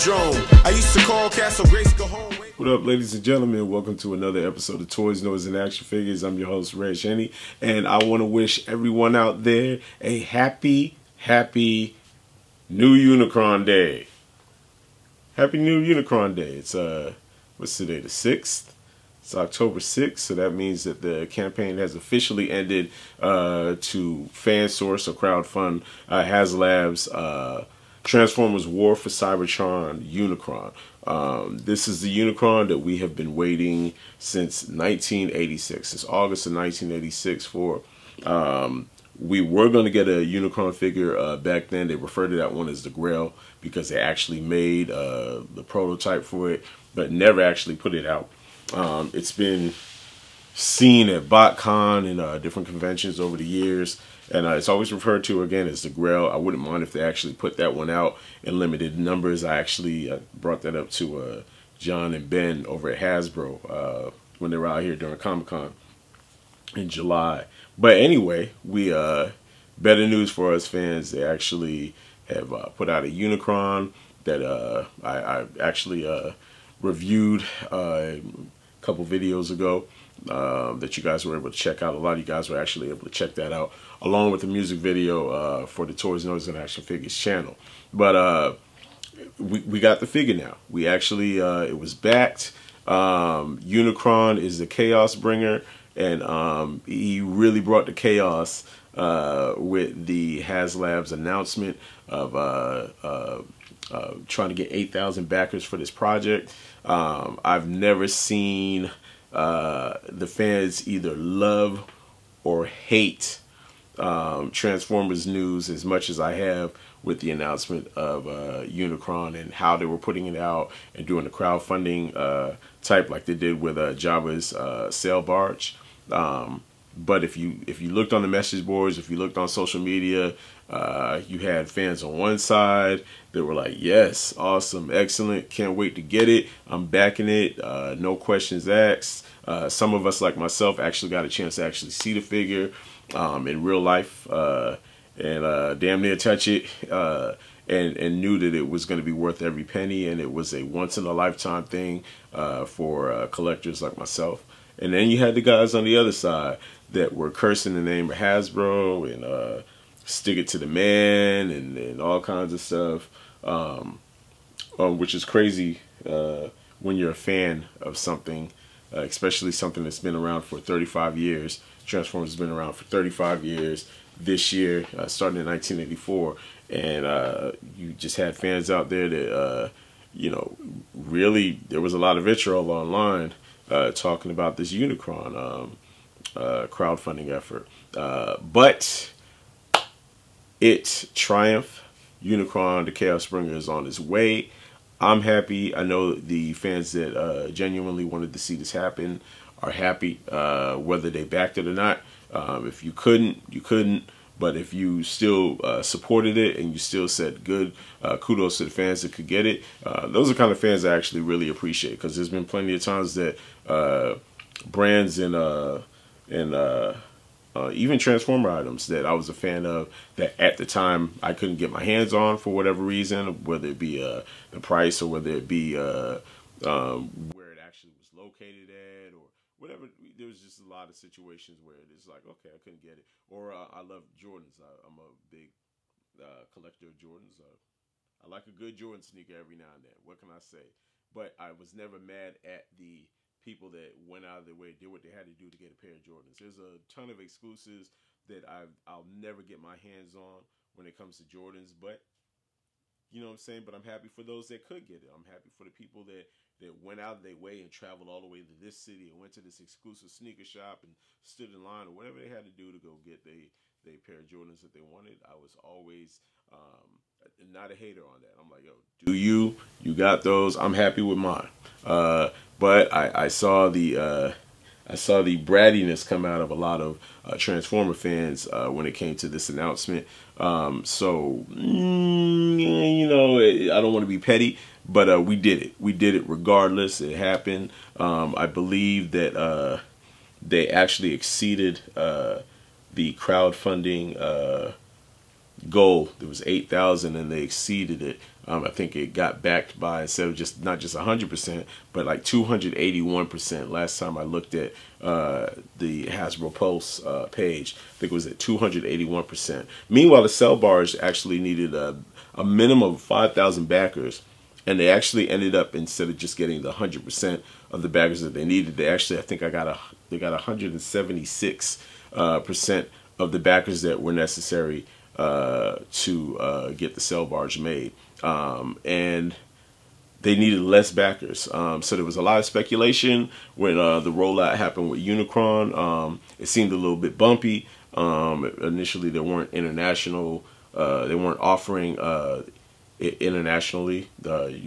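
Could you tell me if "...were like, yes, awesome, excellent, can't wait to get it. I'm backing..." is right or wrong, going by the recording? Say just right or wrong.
right.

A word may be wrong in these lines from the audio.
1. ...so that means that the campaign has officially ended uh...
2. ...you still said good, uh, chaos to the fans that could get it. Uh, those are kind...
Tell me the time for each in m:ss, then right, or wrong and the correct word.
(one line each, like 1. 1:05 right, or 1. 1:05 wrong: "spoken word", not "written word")
1. 0:20 right
2. 3:26 wrong: "kudos", not "chaos".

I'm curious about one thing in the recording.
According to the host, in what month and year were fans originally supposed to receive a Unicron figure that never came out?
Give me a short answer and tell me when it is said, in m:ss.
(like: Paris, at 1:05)
August 1986, at 0:36.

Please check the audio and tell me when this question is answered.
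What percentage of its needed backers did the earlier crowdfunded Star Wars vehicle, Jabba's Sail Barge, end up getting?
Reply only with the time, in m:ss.
5:20.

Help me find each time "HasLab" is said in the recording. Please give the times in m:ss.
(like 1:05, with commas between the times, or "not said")
0:26, 1:40.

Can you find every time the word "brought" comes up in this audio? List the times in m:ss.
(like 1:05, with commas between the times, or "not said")
1:00, 1:37.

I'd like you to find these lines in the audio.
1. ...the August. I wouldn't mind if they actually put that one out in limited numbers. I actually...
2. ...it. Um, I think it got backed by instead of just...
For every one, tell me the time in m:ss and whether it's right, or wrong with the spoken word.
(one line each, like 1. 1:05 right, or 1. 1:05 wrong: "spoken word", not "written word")
1. 0:55 wrong: "Grail", not "August"
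2. 4:58 right.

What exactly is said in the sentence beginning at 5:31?
Um, so there was a lot of speculation when uh, the rollout happened with Unicron.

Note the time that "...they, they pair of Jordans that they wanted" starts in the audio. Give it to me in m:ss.
4:23.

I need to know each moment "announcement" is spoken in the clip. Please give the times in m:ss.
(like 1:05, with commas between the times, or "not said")
1:41, 1:57, 4:39.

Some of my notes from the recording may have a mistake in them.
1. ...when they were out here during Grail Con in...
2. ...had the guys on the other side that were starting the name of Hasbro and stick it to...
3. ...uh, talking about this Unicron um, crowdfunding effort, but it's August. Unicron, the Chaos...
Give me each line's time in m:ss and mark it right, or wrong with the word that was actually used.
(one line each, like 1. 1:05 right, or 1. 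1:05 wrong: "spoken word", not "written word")
1. 1:04 wrong: "Comic", not "Grail"
2. 2:35 wrong: "cursing", not "starting"
3. 3:03 wrong: "Triumph", not "August".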